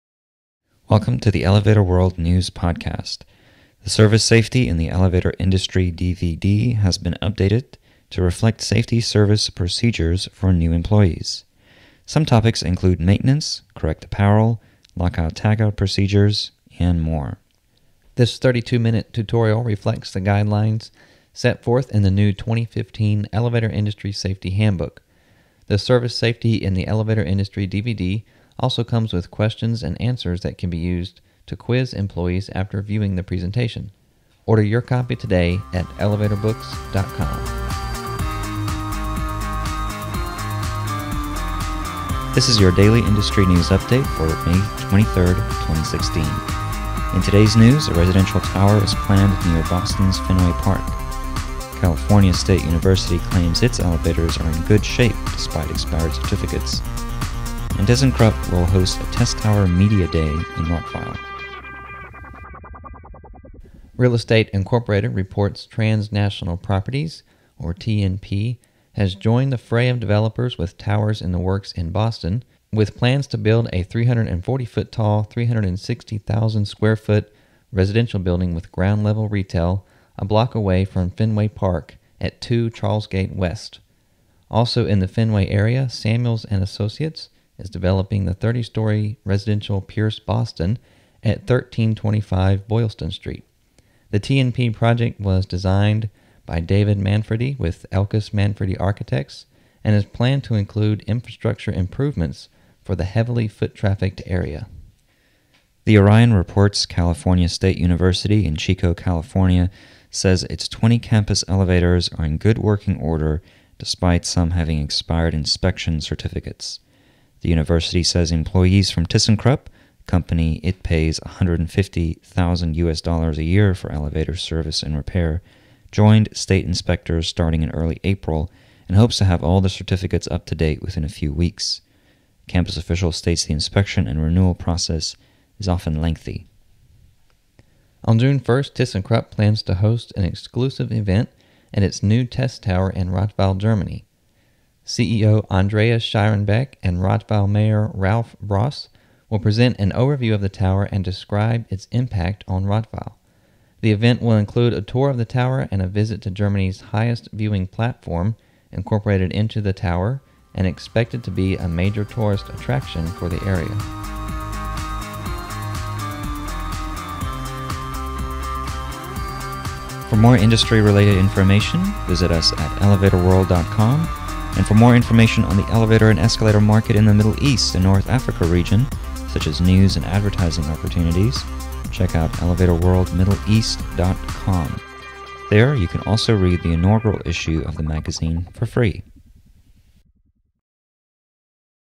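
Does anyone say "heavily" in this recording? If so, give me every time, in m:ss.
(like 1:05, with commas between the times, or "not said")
1:43.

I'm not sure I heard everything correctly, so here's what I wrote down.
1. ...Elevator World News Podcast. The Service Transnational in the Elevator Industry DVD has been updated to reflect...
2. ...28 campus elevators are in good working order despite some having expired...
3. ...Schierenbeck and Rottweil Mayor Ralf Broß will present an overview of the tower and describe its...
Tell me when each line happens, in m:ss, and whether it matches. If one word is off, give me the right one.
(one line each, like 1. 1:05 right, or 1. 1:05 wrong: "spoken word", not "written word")
1. 0:01 wrong: "Safety", not "Transnational"
2. 1:50 wrong: "20", not "28"
3. 2:26 right.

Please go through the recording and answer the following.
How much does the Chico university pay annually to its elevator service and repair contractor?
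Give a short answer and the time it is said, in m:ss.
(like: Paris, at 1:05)
150,000 US dollars, at 2:01.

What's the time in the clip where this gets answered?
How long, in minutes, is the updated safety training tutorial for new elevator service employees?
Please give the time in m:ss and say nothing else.
0:18.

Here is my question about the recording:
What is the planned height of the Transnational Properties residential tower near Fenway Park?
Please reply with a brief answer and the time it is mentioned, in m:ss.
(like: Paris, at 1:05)
340 feet, at 1:13.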